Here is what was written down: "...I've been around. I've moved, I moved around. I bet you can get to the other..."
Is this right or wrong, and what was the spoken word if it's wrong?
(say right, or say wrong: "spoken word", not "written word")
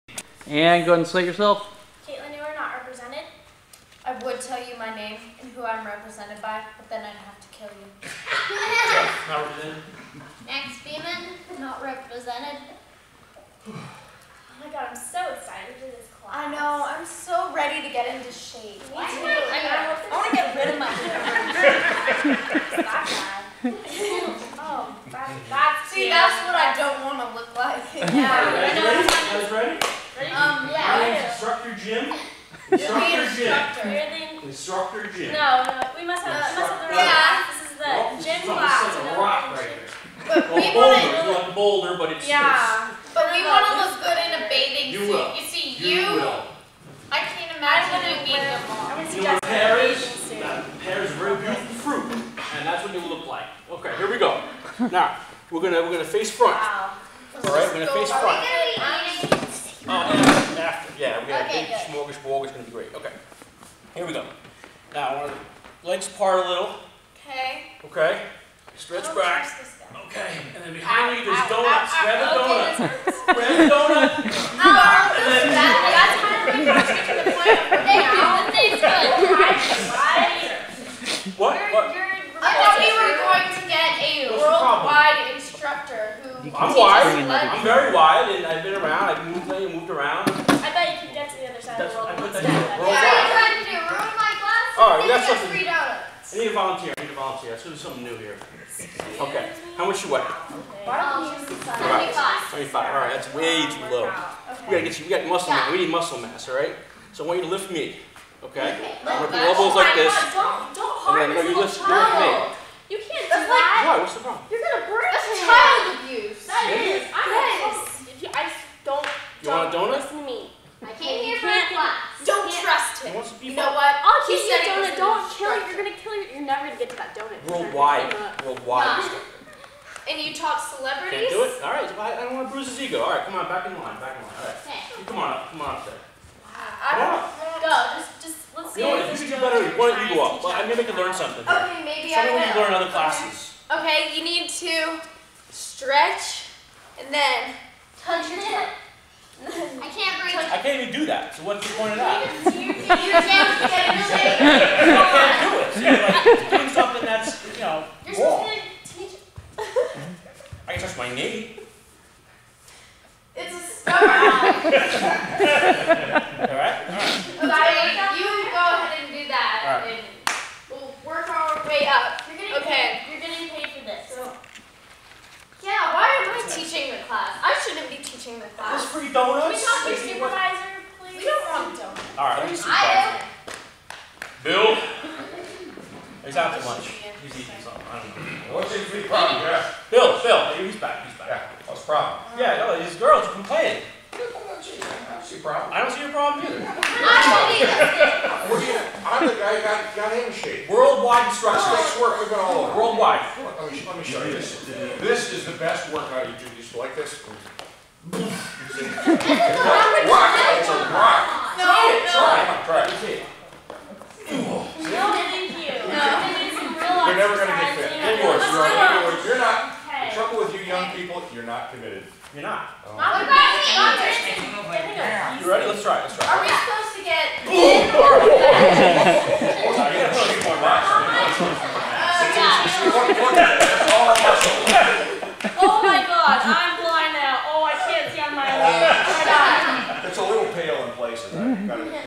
right.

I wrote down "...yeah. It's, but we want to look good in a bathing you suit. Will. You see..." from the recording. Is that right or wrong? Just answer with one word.
right.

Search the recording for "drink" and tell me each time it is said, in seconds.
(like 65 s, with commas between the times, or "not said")
not said.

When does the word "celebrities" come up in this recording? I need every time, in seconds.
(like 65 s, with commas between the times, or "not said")
130 s.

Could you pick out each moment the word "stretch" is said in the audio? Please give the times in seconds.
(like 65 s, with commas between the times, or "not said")
68 s, 145 s.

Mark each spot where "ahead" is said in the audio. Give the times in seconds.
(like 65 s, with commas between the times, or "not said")
0 s, 168 s.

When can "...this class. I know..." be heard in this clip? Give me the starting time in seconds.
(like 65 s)
15 s.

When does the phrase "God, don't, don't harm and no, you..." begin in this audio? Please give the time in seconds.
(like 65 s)
110 s.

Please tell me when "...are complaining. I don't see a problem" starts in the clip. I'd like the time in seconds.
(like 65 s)
193 s.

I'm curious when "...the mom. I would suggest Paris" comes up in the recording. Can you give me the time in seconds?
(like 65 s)
48 s.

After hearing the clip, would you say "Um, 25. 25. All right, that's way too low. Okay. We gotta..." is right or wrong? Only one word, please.
right.